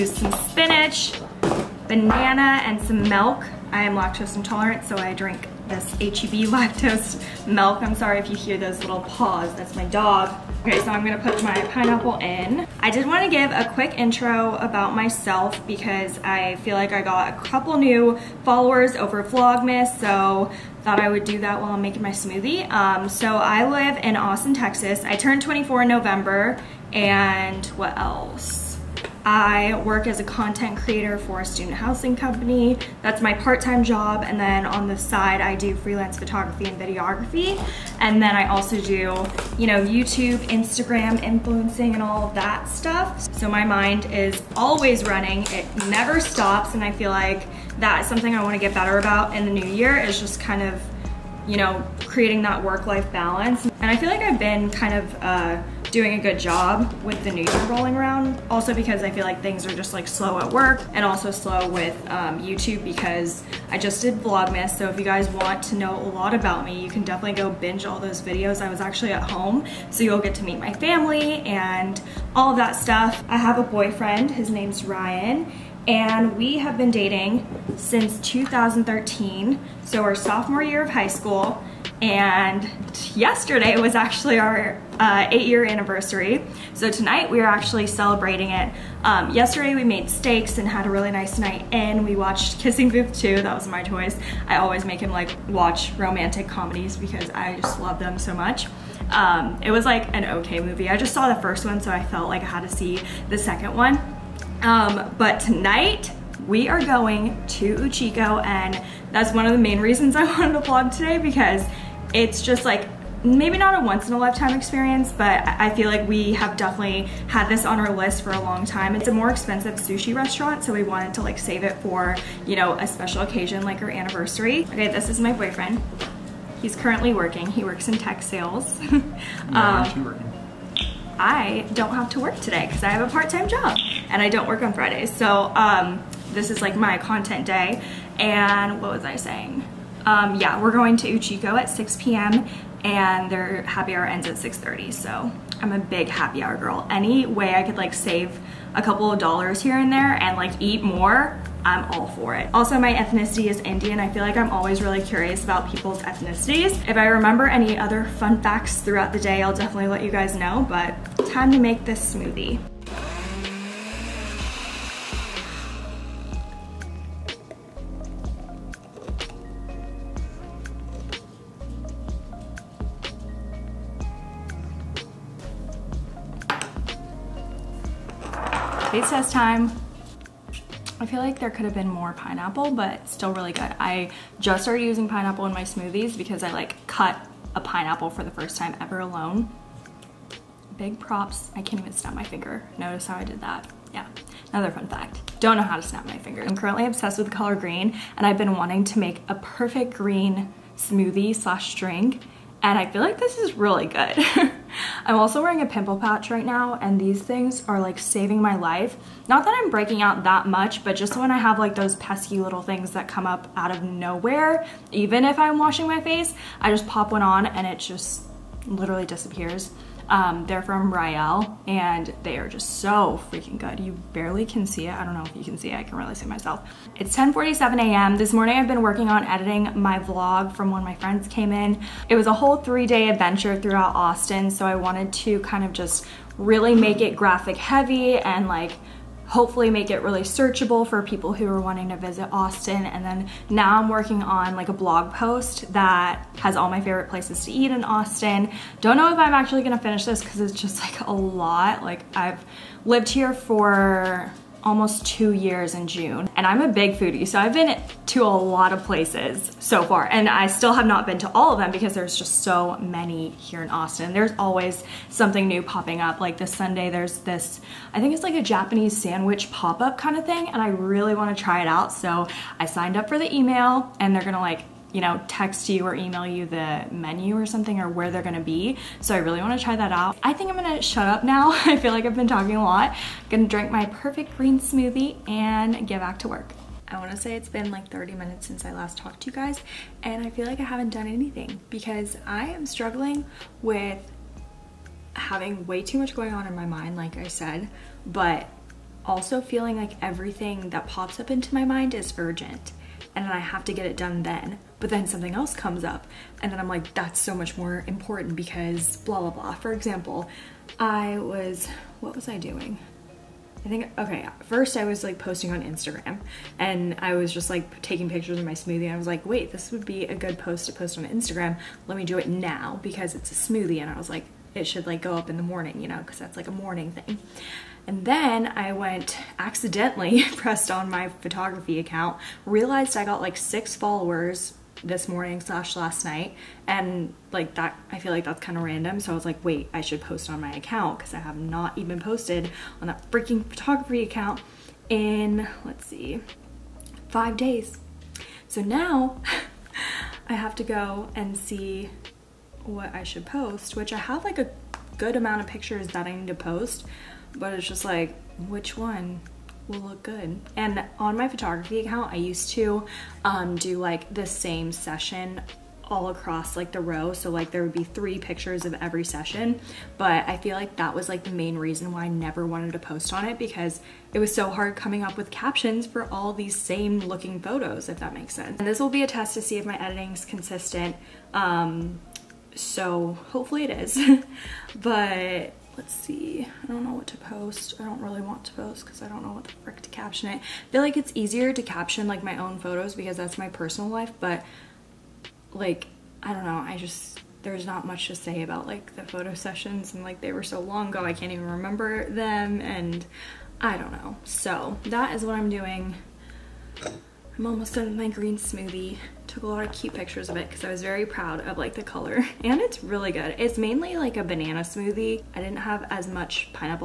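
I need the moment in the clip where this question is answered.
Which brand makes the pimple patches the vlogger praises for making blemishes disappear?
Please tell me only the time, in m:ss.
3:40.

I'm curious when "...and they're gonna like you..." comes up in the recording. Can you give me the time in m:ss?
4:33.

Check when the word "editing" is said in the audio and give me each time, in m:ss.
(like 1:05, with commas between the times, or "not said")
3:49, 6:19.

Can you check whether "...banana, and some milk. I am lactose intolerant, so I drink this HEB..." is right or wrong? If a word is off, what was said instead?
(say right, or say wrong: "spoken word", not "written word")
right.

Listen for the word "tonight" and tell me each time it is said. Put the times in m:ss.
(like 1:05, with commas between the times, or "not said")
1:26, 1:45.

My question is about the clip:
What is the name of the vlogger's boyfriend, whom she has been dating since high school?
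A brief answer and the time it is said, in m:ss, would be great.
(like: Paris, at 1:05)
Ryan, at 1:14.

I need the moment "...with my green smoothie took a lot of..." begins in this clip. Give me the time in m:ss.
6:47.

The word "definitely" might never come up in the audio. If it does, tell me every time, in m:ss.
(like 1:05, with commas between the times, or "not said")
1:07, 1:56, 2:39.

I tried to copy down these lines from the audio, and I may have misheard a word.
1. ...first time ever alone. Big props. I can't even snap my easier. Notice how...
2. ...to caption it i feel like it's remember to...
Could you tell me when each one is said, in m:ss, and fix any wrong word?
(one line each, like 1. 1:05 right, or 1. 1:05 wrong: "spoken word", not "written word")
1. 3:08 wrong: "finger", not "easier"
2. 6:29 wrong: "easier", not "remember".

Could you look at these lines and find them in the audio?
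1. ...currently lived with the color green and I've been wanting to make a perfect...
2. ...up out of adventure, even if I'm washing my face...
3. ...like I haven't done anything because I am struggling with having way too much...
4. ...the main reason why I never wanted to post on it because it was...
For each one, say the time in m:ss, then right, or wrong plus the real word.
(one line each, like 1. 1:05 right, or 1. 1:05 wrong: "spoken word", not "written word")
1. 3:16 wrong: "obsessed", not "lived"
2. 3:33 wrong: "nowhere", not "adventure"
3. 4:50 right
4. 6:11 right.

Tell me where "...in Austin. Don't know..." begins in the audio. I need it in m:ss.
4:07.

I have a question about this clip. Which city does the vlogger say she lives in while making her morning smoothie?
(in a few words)
Austin, Texas.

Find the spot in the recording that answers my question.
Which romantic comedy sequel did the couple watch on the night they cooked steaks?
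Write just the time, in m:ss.
1:32.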